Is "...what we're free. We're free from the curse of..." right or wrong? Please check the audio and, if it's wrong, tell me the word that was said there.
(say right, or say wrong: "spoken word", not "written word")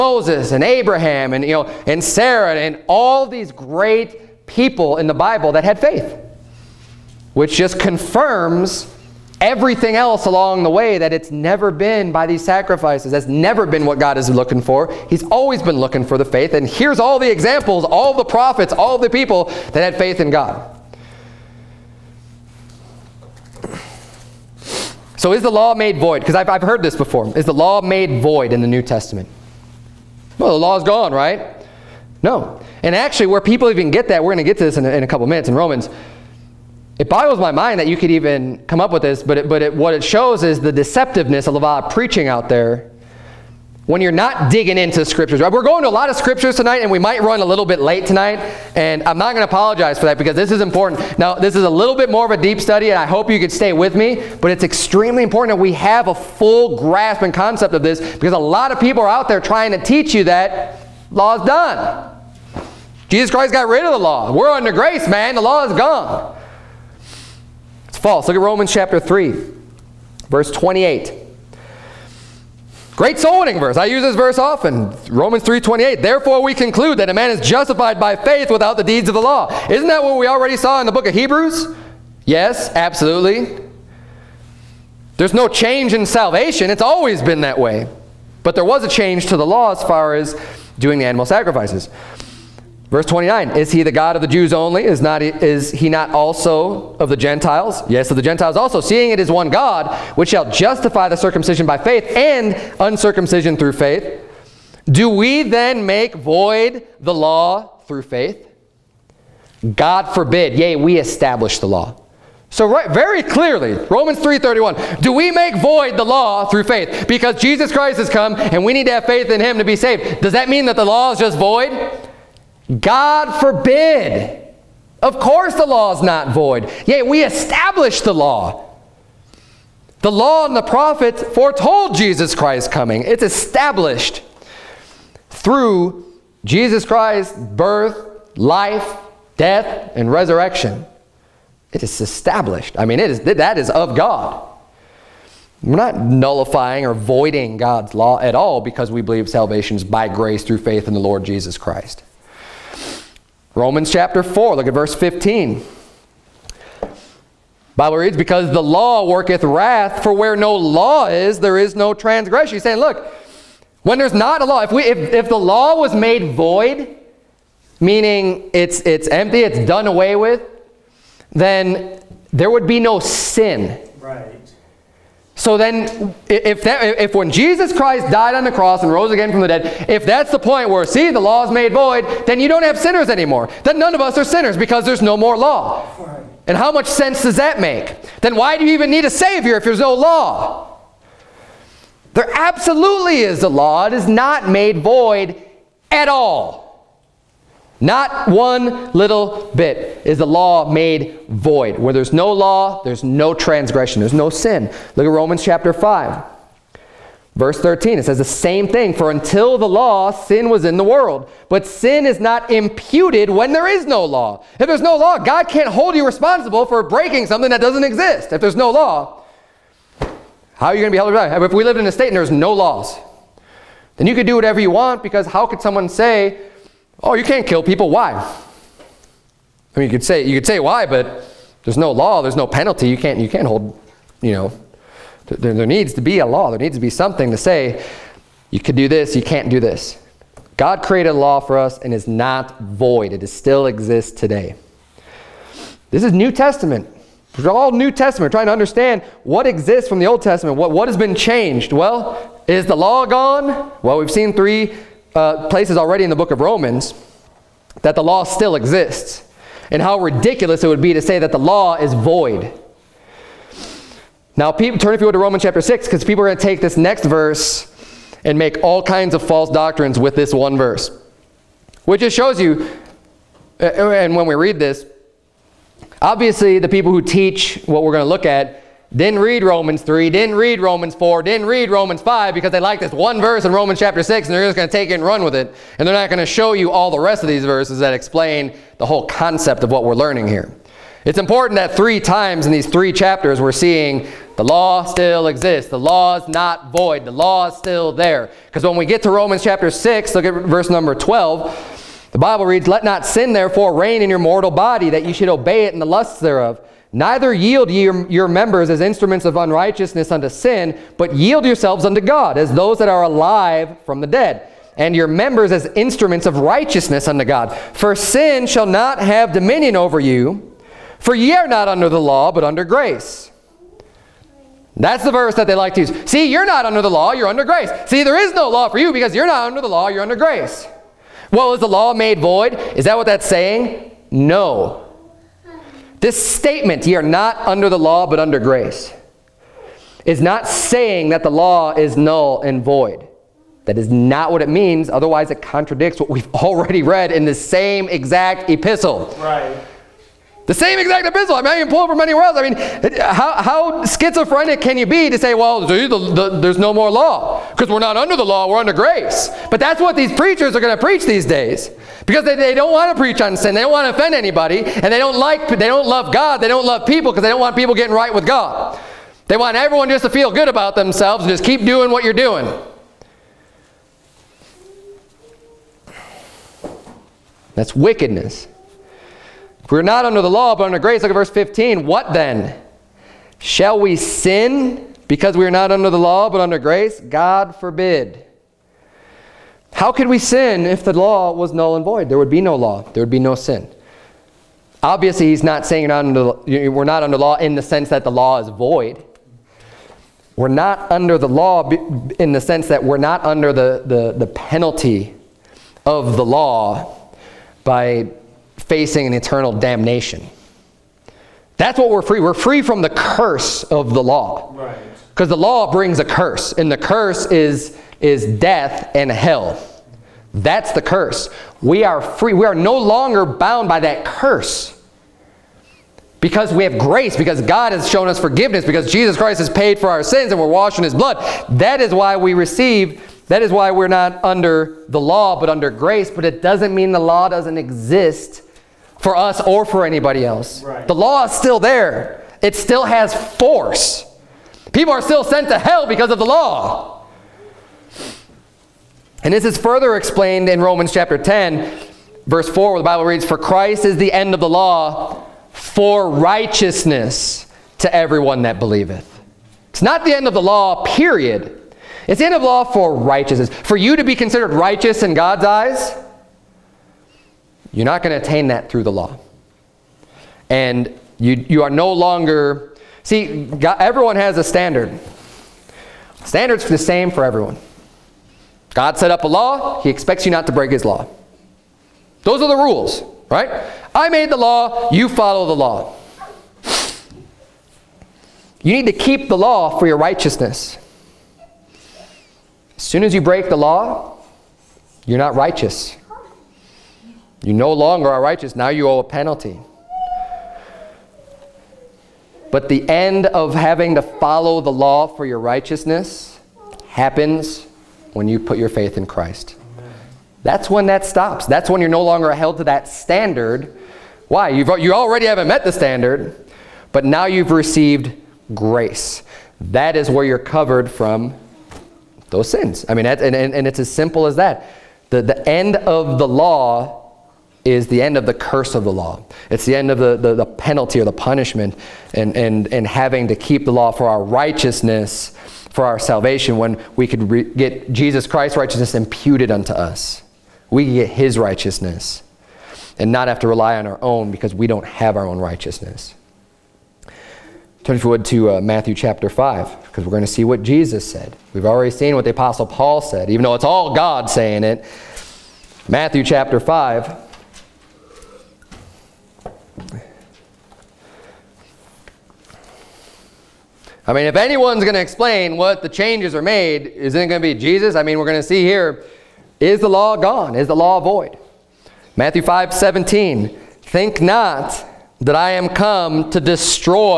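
right.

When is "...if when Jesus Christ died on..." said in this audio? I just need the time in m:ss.
2:57.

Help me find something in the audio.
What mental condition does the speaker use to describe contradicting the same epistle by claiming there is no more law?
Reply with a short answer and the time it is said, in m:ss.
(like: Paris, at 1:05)
Schizophrenic, at 5:53.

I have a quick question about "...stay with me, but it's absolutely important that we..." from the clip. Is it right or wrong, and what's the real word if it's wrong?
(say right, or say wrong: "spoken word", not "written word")
wrong: "extremely", not "absolutely".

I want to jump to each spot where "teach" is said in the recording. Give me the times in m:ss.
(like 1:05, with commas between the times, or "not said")
0:59, 4:37.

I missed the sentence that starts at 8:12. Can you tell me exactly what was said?
As soon as you break the law, you're not righteous.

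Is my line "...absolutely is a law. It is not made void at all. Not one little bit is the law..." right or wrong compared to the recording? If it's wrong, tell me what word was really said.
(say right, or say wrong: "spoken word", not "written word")
right.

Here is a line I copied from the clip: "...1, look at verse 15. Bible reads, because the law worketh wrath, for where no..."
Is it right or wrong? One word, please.
wrong.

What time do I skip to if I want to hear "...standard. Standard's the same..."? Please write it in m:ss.
7:54.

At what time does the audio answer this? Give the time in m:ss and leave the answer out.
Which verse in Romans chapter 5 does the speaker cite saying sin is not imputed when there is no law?
3:27.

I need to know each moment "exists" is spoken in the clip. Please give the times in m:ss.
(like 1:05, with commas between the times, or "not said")
3:37, 4:03, 4:09, 4:18, 4:55, 7:17.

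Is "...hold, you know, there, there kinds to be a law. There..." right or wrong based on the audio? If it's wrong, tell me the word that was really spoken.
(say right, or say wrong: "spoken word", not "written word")
wrong: "needs", not "kinds".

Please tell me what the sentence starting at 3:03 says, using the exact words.
Then none of us are sinners because there's no more law.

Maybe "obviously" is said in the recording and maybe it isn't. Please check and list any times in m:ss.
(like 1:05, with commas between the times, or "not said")
4:36, 6:34.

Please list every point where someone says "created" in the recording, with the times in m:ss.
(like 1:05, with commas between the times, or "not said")
4:00.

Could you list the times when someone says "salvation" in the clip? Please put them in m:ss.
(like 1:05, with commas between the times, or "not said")
1:26, 2:29, 8:55.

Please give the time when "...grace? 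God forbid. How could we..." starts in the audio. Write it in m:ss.
6:26.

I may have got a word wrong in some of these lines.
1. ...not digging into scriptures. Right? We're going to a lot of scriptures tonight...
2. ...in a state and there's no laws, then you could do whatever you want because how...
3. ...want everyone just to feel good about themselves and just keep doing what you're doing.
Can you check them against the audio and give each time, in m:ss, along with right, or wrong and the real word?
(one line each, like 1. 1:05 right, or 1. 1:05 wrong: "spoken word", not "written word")
1. 0:44 right
2. 3:41 right
3. 6:09 right.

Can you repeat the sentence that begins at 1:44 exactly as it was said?
Do we then make void the law through faith?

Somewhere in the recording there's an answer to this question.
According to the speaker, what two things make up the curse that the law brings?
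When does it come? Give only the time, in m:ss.
6:58.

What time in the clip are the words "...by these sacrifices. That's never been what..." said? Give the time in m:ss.
0:12.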